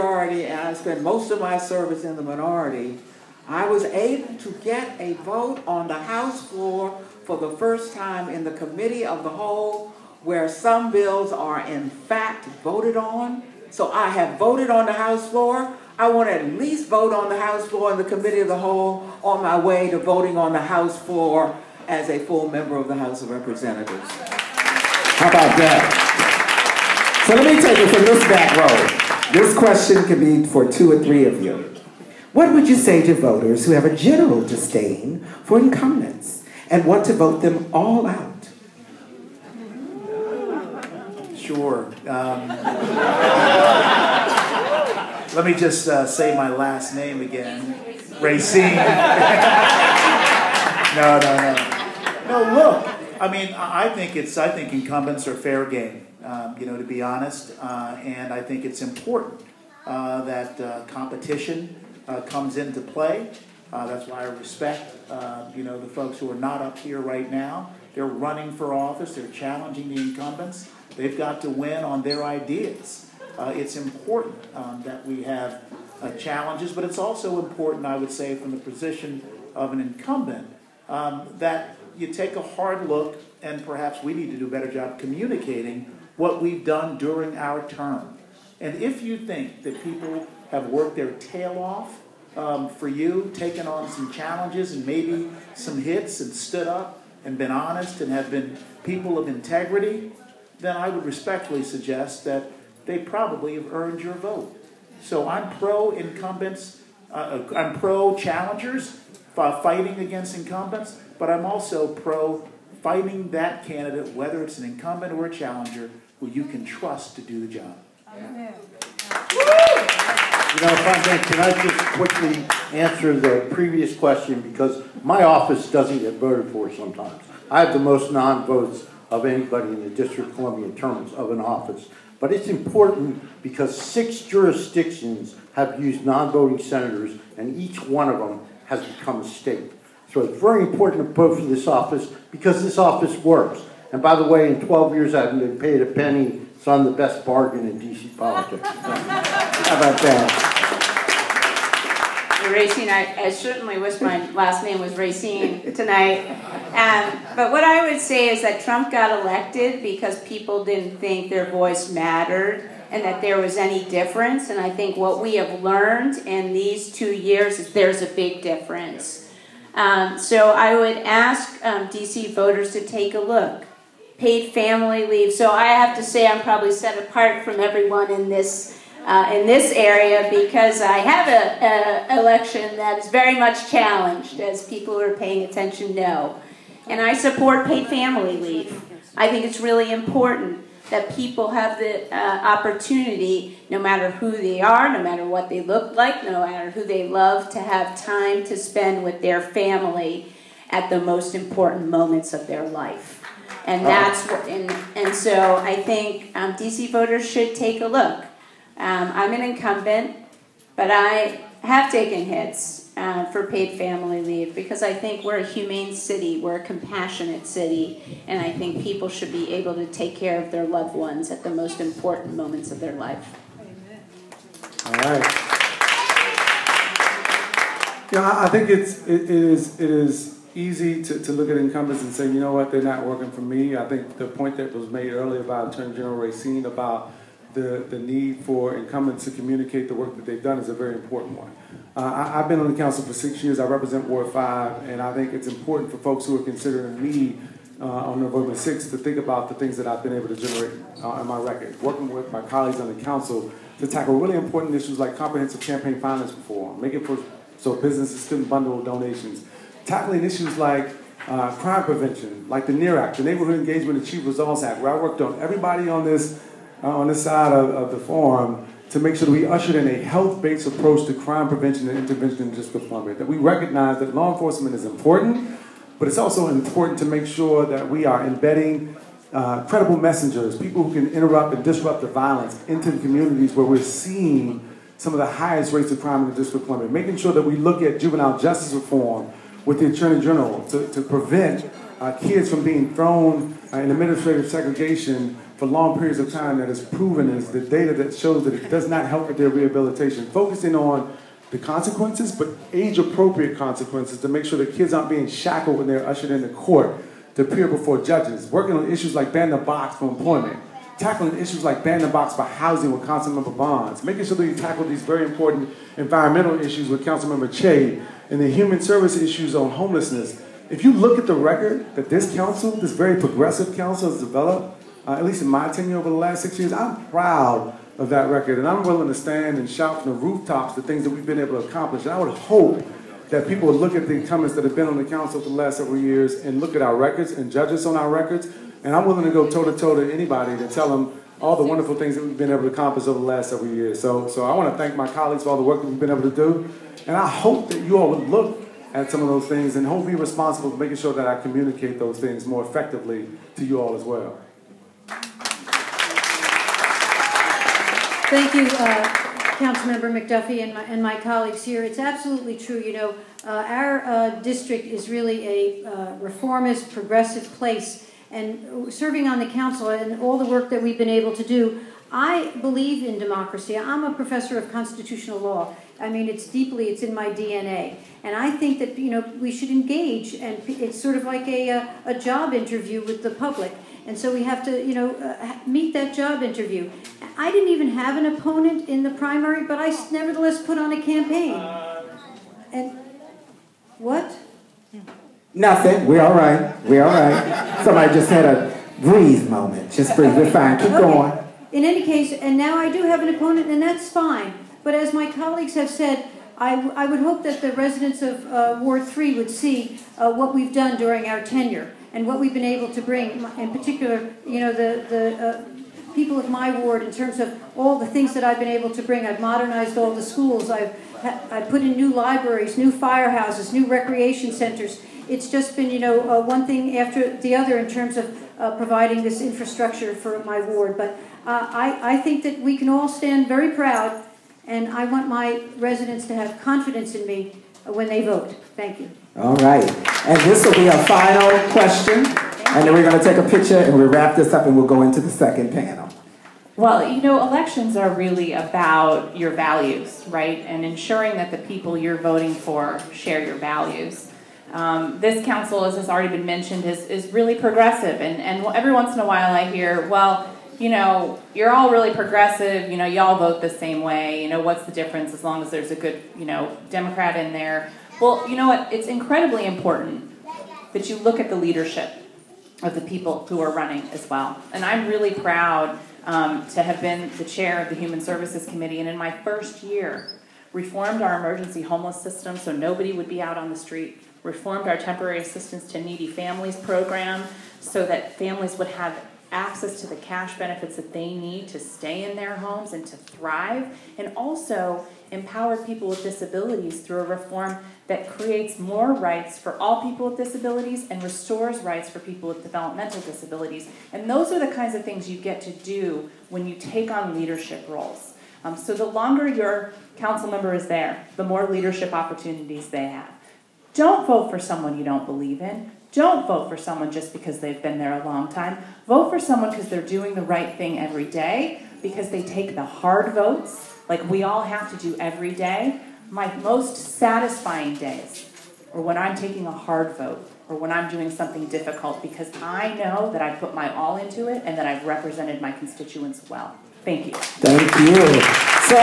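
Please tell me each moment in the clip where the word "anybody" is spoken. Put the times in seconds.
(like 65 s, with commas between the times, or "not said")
129 s, 340 s.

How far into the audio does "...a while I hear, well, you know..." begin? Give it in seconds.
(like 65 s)
459 s.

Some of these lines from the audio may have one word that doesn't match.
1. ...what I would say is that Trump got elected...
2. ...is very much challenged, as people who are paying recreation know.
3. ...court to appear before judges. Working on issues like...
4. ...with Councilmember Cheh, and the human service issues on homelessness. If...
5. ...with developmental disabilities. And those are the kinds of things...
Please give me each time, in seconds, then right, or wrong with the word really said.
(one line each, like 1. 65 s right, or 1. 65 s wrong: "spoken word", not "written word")
1. 157 s right
2. 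182 s wrong: "attention", not "recreation"
3. 306 s right
4. 316 s right
5. 502 s right.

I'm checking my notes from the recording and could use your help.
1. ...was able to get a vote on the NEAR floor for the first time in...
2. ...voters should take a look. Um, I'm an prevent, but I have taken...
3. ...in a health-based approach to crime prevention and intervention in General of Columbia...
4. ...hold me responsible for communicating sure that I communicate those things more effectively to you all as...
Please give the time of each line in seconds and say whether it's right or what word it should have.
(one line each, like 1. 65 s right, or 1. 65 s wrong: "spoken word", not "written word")
1. 3 s wrong: "House", not "NEAR"
2. 206 s wrong: "incumbent", not "prevent"
3. 269 s wrong: "District", not "General"
4. 349 s wrong: "making", not "communicating".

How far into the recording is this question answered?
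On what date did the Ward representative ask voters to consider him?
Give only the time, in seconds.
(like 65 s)
248 s.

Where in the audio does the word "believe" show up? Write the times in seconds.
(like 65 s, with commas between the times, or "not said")
372 s, 515 s.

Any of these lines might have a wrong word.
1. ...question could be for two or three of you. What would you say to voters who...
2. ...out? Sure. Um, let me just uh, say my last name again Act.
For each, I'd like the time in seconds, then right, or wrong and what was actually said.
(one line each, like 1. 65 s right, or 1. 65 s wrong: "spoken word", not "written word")
1. 29 s right
2. 38 s wrong: "Racine", not "Act".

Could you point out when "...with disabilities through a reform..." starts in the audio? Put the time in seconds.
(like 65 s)
496 s.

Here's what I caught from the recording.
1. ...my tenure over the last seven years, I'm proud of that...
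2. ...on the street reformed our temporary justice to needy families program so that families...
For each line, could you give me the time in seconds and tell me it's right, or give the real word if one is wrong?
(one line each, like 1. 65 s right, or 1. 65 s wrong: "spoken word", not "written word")
1. 325 s wrong: "six", not "seven"
2. 483 s wrong: "assistance", not "justice".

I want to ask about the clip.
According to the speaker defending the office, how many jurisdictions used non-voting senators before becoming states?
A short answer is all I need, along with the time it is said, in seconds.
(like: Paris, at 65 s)
6, at 133 s.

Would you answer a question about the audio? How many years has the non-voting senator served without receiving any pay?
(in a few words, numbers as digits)
12.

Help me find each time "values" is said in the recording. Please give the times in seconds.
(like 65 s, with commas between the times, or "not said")
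449 s, 453 s.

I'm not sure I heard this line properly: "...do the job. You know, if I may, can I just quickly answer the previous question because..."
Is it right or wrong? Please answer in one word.
right.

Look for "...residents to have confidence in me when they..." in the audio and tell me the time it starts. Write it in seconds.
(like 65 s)
435 s.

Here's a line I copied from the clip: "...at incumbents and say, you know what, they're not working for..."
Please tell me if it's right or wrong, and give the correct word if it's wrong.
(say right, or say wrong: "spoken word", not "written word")
right.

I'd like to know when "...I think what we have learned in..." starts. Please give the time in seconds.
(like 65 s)
164 s.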